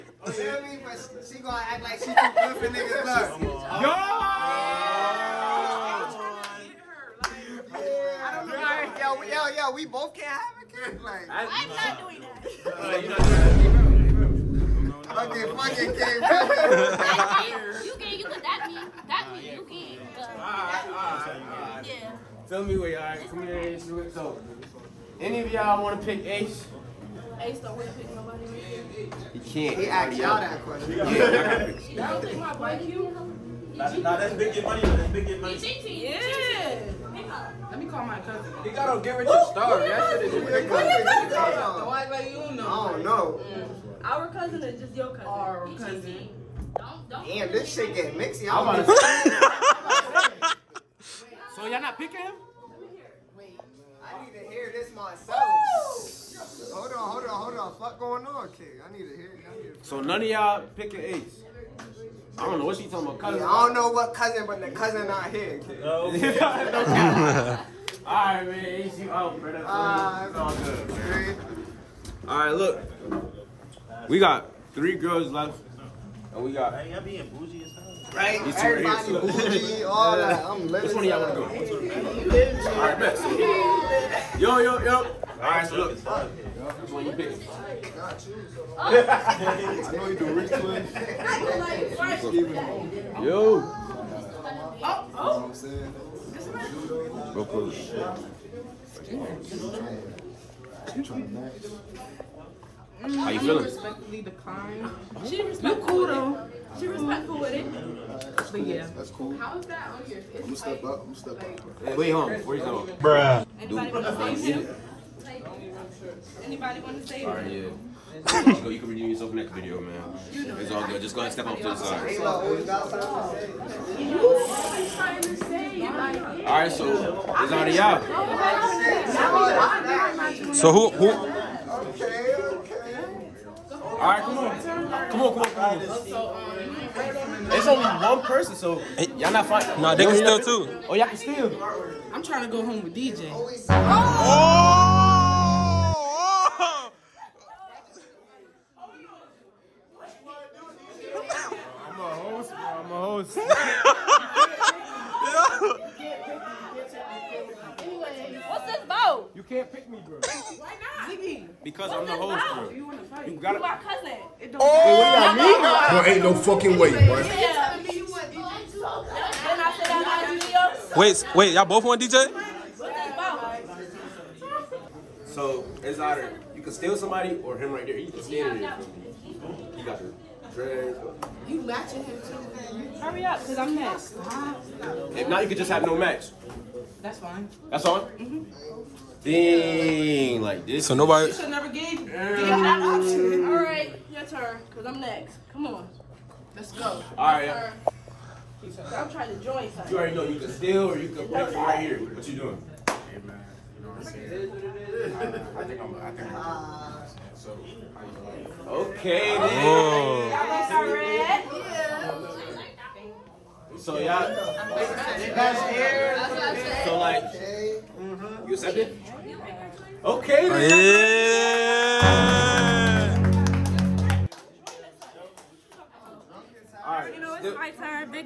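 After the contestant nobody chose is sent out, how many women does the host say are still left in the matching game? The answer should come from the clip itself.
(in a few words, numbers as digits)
3.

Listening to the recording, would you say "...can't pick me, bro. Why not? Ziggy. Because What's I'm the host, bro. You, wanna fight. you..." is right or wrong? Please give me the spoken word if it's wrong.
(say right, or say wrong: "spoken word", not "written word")
right.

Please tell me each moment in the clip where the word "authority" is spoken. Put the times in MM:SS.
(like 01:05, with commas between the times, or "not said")
not said.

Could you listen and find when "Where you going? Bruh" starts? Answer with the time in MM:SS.
01:52.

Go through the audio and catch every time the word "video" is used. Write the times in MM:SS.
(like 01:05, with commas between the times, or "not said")
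01:59.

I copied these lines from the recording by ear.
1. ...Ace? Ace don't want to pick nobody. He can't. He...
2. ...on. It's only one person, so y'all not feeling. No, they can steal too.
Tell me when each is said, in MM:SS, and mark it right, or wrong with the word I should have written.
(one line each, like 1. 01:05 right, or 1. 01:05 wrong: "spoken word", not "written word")
1. 00:26 right
2. 02:15 wrong: "fighting", not "feeling".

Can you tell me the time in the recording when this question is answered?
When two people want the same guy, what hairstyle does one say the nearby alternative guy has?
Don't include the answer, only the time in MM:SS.
03:00.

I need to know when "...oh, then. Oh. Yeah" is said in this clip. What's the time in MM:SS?
03:29.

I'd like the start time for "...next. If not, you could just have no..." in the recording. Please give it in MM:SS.
03:03.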